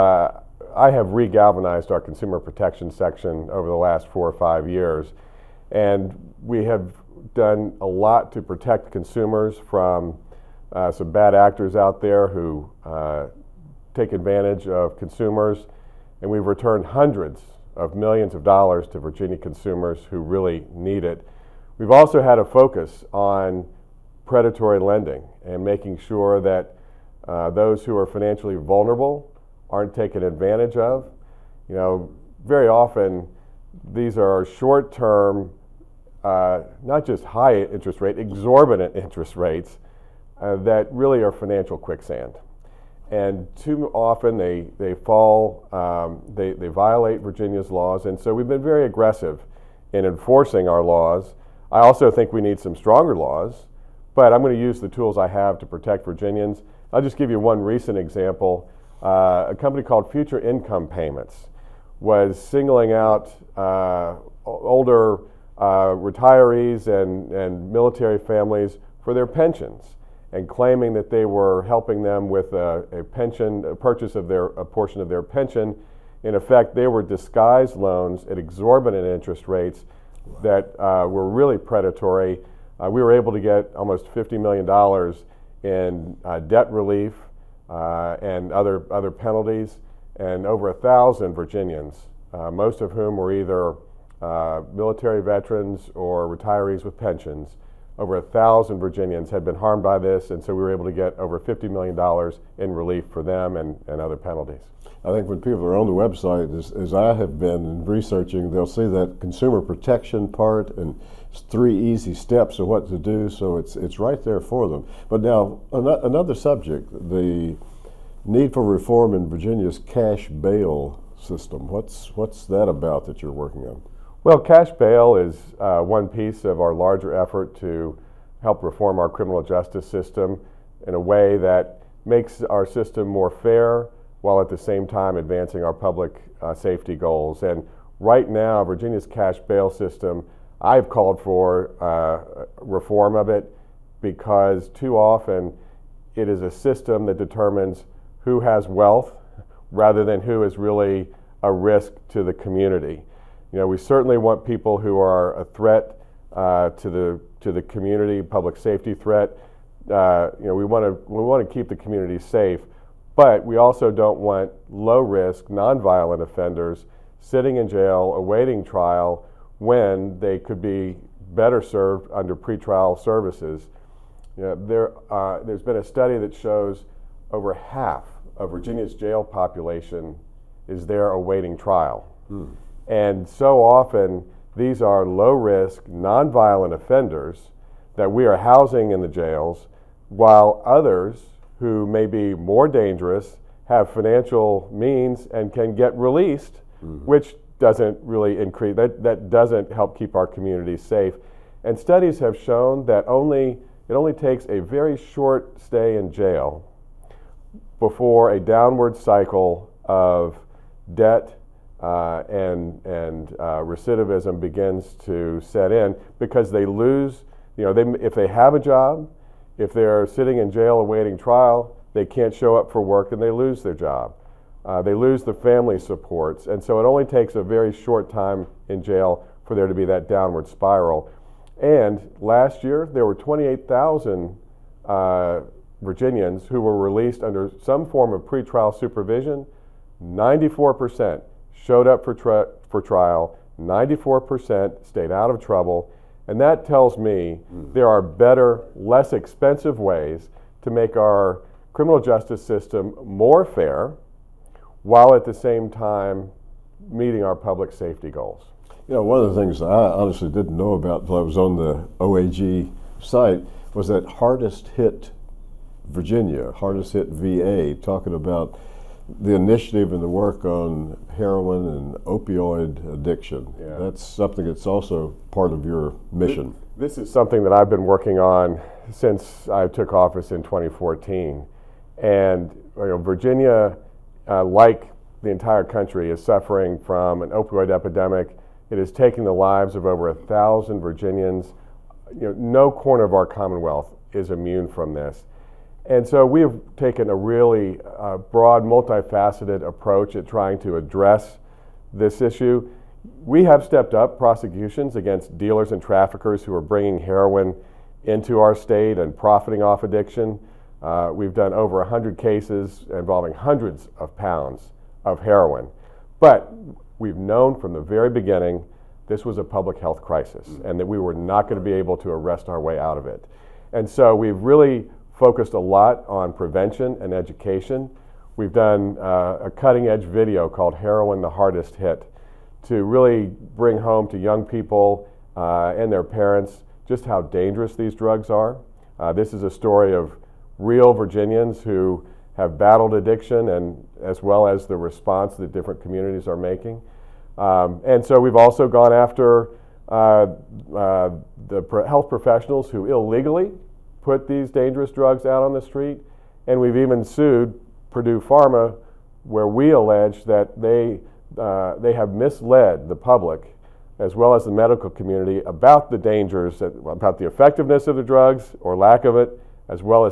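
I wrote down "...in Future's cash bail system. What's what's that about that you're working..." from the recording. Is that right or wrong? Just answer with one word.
wrong.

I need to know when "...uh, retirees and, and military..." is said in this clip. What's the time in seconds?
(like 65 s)
65 s.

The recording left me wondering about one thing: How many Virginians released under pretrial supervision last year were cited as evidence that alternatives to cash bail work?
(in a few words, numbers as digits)
28,000.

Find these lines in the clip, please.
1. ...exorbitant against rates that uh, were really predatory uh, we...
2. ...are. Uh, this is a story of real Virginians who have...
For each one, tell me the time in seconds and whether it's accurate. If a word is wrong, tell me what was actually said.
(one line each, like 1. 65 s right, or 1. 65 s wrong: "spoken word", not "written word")
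1. 78 s wrong: "interest", not "against"
2. 338 s right.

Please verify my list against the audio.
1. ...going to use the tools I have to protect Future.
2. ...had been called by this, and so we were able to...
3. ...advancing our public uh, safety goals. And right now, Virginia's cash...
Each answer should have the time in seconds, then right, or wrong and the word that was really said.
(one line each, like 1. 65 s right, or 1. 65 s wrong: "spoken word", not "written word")
1. 54 s wrong: "Virginians", not "Future"
2. 99 s wrong: "harmed", not "called"
3. 135 s right.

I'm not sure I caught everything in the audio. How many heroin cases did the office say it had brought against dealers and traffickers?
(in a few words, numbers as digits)
over 100.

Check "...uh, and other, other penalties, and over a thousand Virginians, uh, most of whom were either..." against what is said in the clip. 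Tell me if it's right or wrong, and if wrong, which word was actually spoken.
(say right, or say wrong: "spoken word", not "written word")
right.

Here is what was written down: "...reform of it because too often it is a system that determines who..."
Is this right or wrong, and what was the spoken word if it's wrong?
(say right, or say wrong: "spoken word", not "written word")
right.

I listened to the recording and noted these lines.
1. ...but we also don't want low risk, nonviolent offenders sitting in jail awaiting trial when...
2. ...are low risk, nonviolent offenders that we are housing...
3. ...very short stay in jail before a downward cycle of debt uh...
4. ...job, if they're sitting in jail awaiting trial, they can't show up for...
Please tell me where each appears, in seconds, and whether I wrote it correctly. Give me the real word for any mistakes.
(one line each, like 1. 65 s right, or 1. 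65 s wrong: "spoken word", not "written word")
1. 163 s right
2. 184 s right
3. 204 s right
4. 218 s right.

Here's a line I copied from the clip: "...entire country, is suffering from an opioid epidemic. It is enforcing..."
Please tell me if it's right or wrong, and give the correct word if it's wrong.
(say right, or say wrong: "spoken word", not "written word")
wrong: "taking", not "enforcing".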